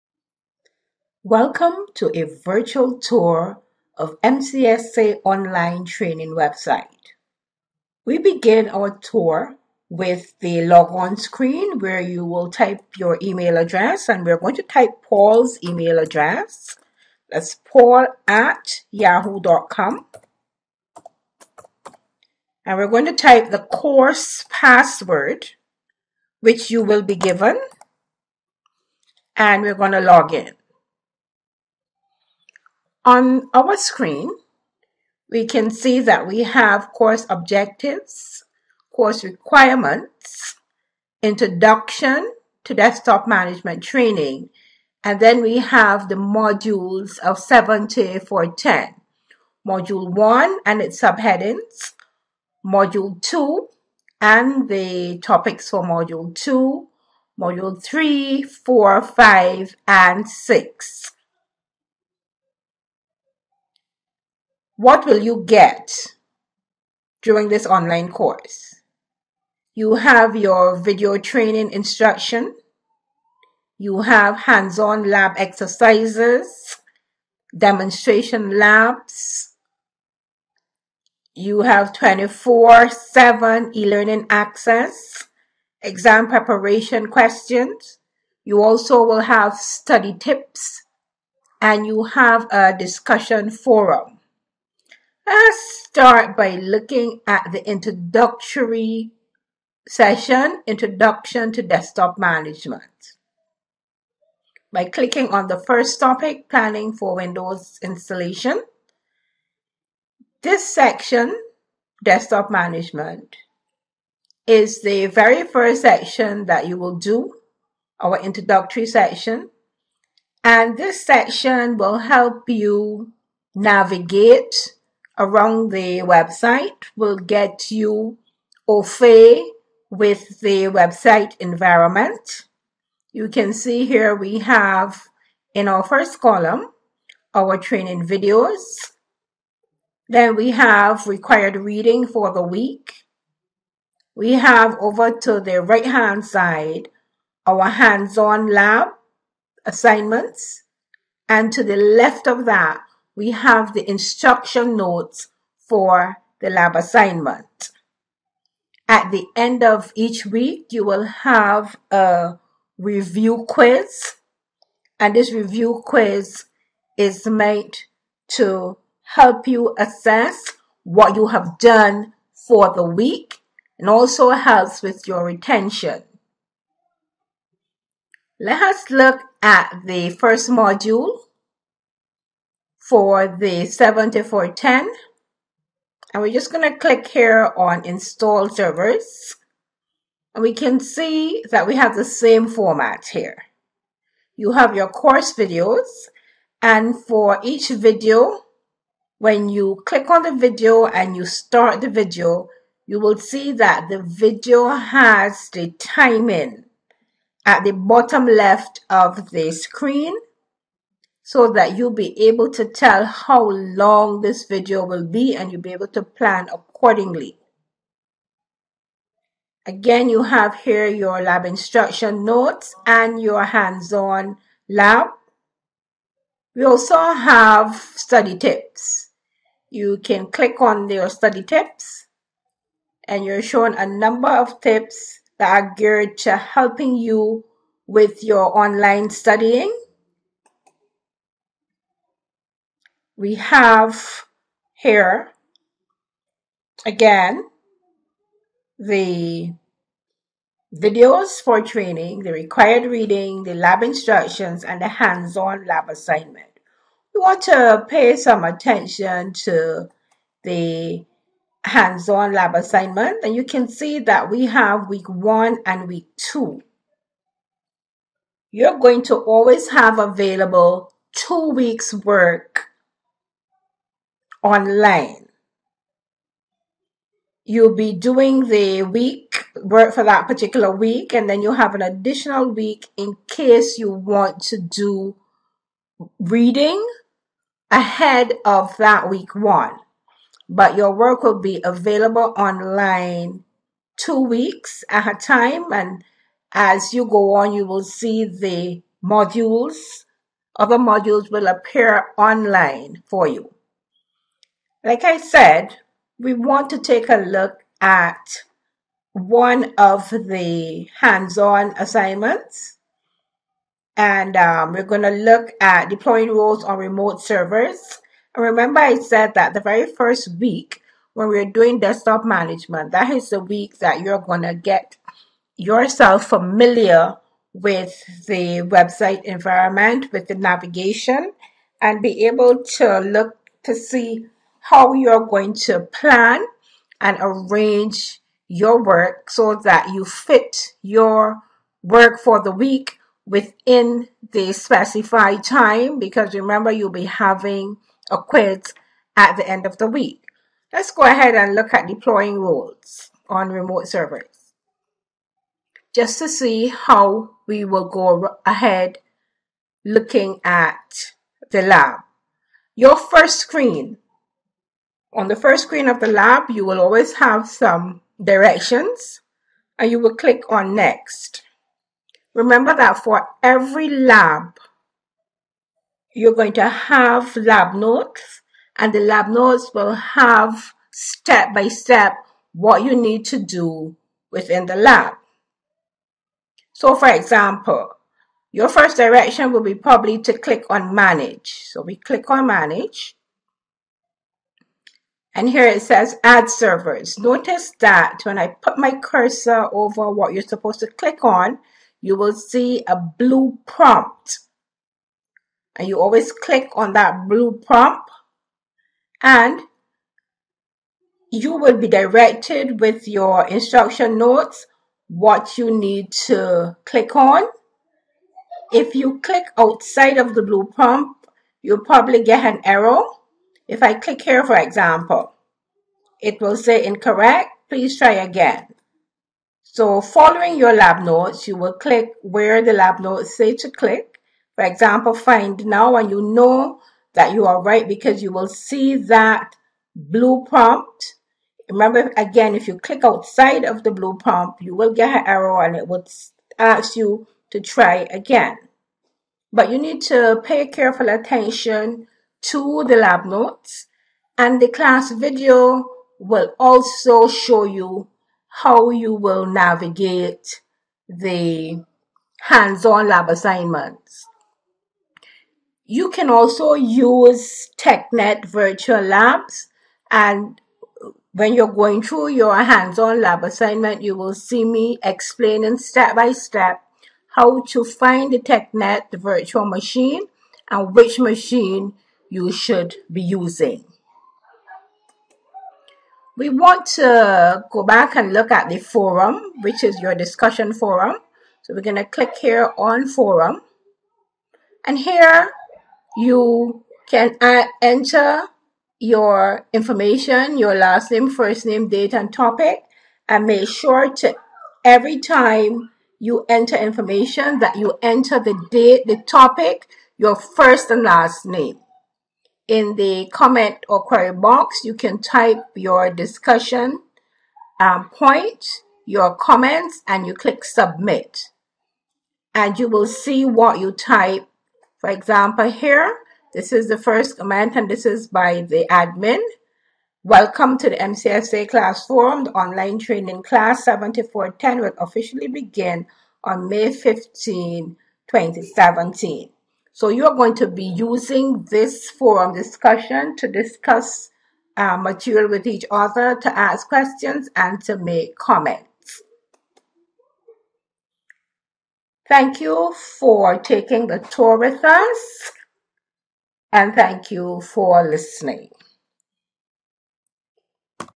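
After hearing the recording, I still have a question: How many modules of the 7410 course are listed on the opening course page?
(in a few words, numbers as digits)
6.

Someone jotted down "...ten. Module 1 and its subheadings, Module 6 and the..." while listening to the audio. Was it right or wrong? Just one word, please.
wrong.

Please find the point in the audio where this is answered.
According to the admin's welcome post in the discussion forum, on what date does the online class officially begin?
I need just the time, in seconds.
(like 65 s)
536 s.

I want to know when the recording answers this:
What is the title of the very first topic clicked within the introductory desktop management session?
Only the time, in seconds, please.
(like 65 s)
106 s.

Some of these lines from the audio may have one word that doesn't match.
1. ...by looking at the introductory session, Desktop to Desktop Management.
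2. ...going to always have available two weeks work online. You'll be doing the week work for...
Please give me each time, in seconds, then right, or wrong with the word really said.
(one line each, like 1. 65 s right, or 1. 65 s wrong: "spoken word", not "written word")
1. 96 s wrong: "Introduction", not "Desktop"
2. 268 s right.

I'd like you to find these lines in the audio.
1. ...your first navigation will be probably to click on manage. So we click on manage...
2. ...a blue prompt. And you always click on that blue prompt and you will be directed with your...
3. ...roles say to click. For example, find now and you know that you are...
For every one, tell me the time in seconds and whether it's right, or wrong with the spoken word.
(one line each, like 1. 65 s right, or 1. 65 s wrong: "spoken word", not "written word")
1. 388 s wrong: "direction", not "navigation"
2. 402 s right
3. 432 s wrong: "notes", not "roles".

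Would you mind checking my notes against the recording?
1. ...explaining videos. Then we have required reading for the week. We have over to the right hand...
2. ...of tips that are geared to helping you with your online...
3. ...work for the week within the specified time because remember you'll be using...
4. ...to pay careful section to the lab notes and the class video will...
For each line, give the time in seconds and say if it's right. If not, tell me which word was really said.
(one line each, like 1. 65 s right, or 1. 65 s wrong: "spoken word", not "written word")
1. 137 s wrong: "training", not "explaining"
2. 234 s right
3. 341 s wrong: "having", not "using"
4. 450 s wrong: "attention", not "section".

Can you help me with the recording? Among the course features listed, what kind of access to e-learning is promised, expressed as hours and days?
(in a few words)
24-7.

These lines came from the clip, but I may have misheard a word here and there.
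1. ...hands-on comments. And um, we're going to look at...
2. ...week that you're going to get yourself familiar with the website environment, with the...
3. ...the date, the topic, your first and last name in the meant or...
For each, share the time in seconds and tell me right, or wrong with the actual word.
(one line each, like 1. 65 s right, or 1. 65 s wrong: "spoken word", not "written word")
1. 310 s wrong: "assignments", not "comments"
2. 323 s right
3. 508 s wrong: "comment", not "meant".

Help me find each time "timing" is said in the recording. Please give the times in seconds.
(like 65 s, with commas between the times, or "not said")
205 s.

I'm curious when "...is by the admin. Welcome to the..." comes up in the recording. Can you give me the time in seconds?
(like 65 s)
528 s.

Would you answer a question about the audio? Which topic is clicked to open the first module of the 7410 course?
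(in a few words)
install servers.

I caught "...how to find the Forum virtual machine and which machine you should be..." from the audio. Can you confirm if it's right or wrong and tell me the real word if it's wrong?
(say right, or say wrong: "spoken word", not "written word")
wrong: "TechNet", not "Forum".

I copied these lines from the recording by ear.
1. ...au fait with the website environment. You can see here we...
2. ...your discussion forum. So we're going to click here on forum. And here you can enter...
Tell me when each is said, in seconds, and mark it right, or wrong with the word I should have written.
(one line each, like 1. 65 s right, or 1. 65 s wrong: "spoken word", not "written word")
1. 128 s right
2. 490 s right.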